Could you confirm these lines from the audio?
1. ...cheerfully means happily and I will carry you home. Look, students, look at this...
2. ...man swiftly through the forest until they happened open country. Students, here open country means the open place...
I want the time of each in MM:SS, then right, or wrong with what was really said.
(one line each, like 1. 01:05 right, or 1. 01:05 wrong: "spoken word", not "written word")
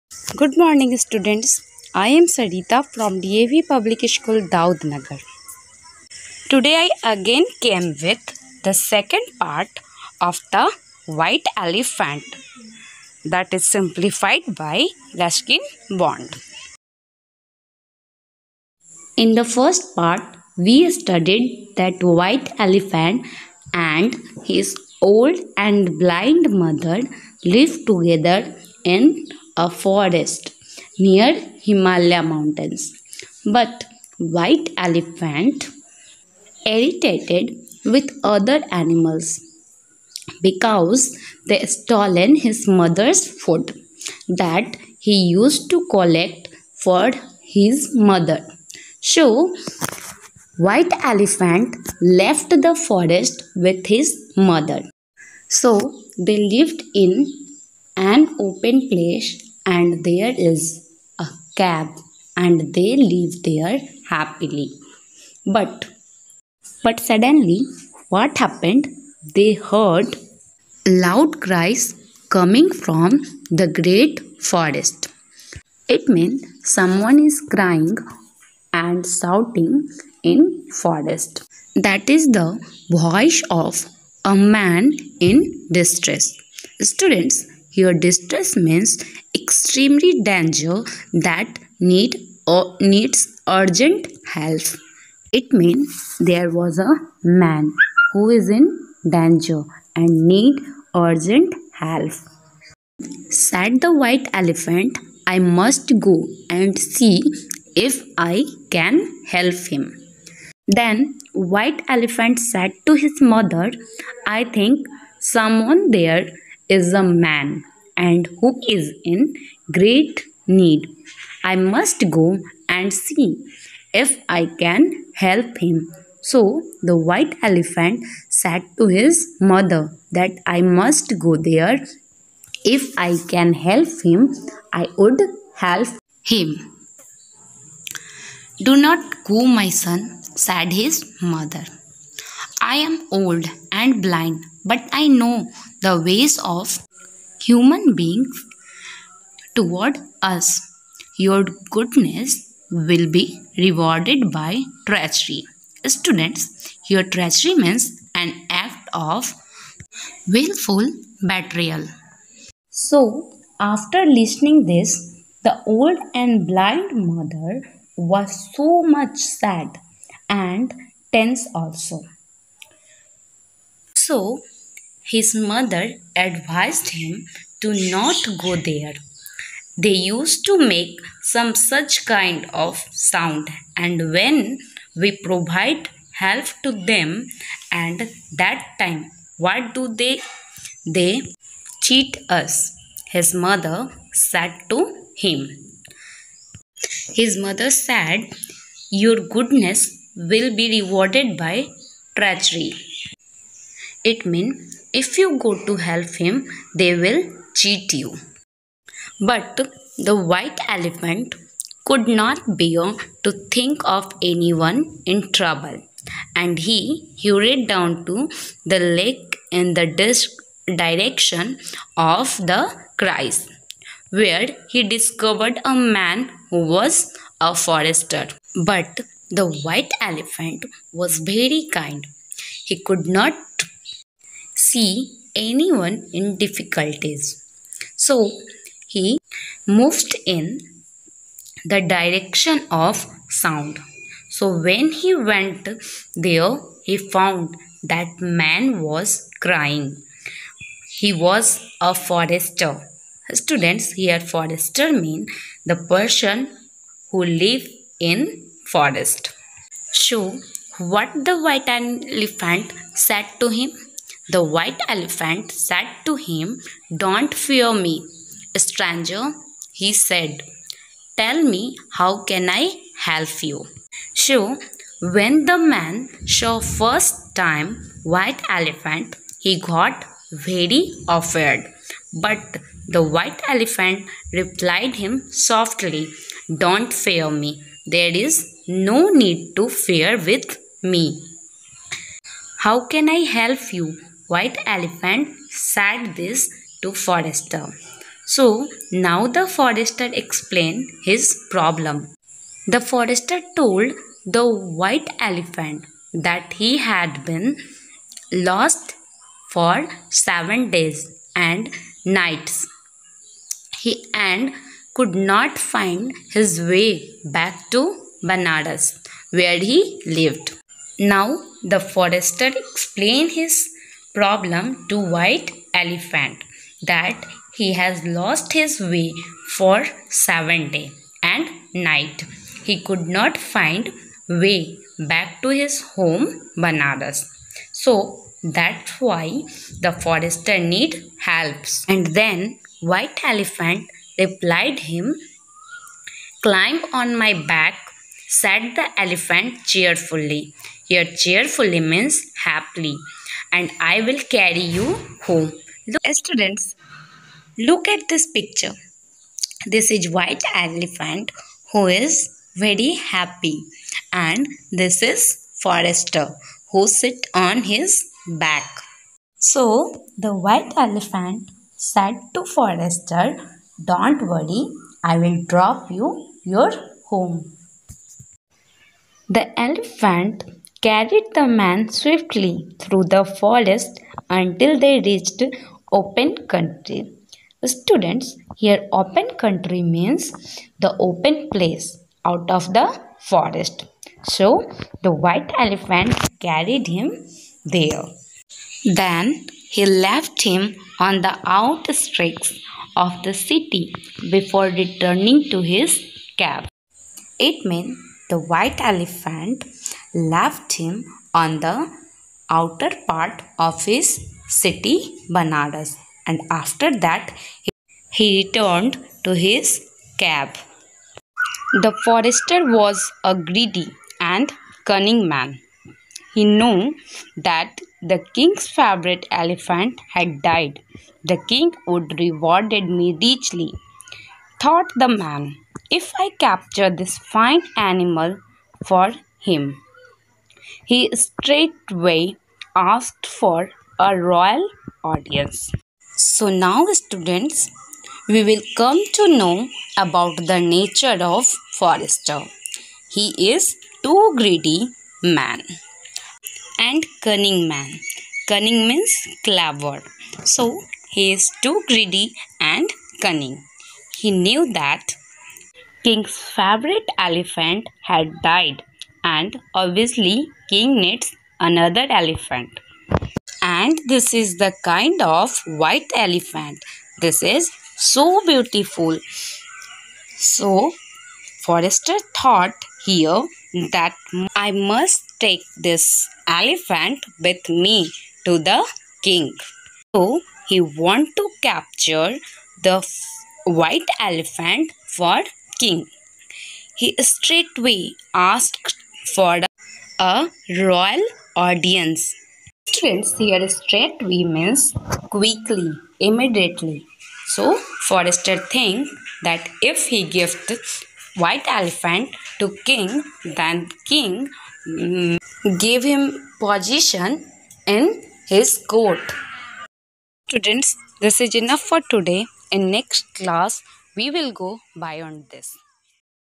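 1. 05:51 right
2. 06:21 wrong: "reached", not "happened".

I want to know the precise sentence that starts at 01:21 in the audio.
That is the voice of a man in distress.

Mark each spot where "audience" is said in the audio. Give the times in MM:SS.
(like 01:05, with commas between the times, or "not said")
07:25, 08:21.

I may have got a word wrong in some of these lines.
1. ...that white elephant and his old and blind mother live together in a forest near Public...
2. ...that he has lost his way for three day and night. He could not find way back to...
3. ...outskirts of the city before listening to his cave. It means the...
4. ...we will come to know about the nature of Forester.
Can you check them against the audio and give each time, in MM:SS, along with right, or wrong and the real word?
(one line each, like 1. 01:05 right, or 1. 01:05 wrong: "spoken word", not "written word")
1. 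00:21 wrong: "Himalaya", not "Public"
2. 05:26 wrong: "seven", not "three"
3. 06:41 wrong: "returning", not "listening"
4. 07:28 right.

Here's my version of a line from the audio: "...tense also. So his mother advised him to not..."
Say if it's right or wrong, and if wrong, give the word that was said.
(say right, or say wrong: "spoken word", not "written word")
right.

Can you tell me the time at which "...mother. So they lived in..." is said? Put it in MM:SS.
00:54.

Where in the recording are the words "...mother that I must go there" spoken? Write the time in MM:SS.
02:09.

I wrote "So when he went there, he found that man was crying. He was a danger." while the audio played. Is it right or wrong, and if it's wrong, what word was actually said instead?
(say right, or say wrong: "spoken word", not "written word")
wrong: "forester", not "danger".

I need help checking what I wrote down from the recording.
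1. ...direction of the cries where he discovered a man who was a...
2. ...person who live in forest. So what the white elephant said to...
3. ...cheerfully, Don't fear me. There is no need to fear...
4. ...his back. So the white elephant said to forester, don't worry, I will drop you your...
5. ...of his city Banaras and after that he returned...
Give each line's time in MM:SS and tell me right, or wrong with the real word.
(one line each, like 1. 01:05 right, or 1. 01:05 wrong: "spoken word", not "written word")
1. 03:40 right
2. 04:15 right
3. 04:45 wrong: "softly", not "cheerfully"
4. 06:07 right
5. 06:53 right.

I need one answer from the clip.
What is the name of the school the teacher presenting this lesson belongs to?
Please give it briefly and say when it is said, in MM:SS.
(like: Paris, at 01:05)
DAV Public School Daudnagar, at 00:03.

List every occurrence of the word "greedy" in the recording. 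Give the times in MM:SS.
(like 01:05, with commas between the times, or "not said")
07:03, 07:34, 07:41.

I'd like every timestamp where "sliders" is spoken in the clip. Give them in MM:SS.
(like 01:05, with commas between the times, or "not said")
not said.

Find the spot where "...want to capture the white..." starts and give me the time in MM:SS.
08:10.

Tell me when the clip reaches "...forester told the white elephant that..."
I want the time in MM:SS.
05:02.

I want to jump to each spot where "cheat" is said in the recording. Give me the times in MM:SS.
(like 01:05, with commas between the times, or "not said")
03:11, 03:27.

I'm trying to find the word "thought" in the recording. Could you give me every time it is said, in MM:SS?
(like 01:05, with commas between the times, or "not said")
07:14, 08:02.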